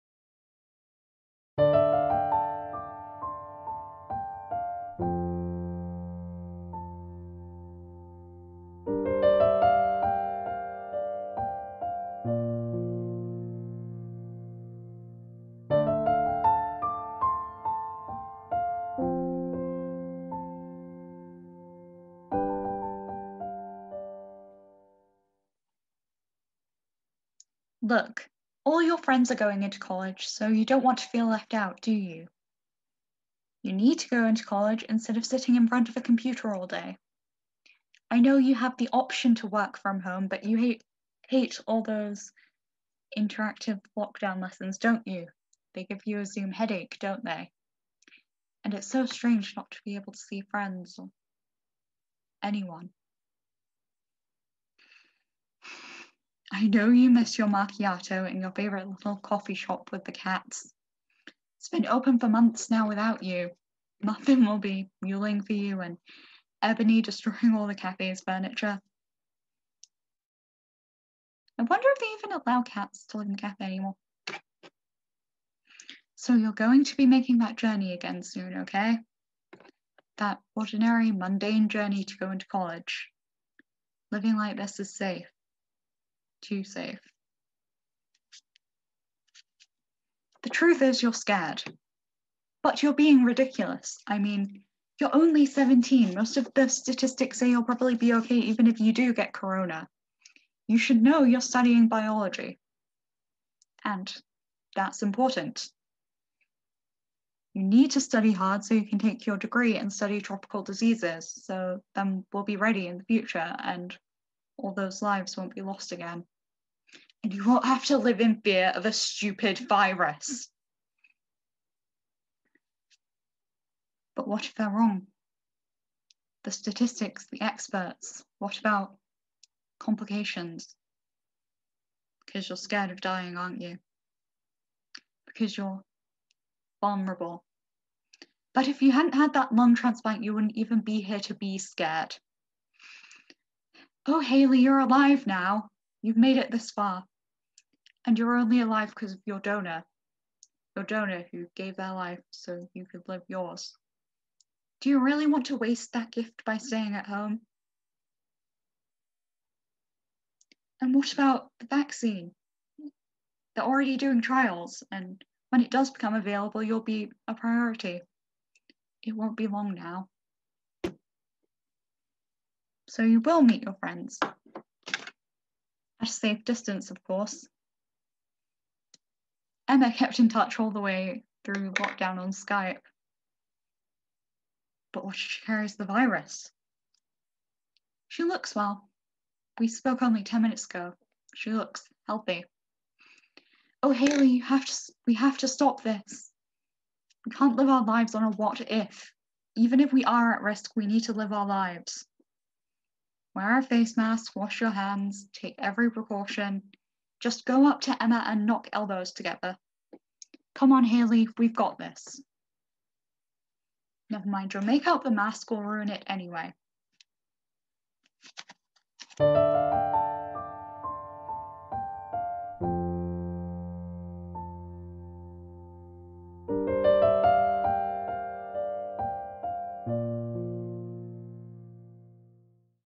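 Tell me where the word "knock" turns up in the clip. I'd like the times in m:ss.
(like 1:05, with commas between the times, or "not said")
3:28.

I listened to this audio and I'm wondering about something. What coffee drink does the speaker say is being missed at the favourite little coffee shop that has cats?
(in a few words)
macchiato.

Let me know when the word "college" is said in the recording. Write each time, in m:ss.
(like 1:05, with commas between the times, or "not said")
0:29, 0:34, 1:22.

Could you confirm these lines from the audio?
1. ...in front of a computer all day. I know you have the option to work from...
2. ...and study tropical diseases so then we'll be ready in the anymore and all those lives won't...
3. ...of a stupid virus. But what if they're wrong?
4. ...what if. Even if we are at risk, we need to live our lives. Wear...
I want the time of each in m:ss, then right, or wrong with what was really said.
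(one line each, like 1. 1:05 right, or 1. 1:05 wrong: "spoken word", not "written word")
1. 0:35 right
2. 1:49 wrong: "future", not "anymore"
3. 1:58 right
4. 3:18 right.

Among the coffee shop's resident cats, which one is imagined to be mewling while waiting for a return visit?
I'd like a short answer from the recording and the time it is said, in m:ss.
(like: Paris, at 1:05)
Muffin, at 1:04.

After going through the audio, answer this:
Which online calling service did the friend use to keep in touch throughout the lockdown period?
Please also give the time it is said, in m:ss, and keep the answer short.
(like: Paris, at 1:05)
Skype, at 3:02.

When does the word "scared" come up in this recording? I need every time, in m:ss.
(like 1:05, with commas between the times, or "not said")
1:31, 2:12, 2:21.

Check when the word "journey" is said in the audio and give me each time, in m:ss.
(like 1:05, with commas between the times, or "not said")
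1:17, 1:21.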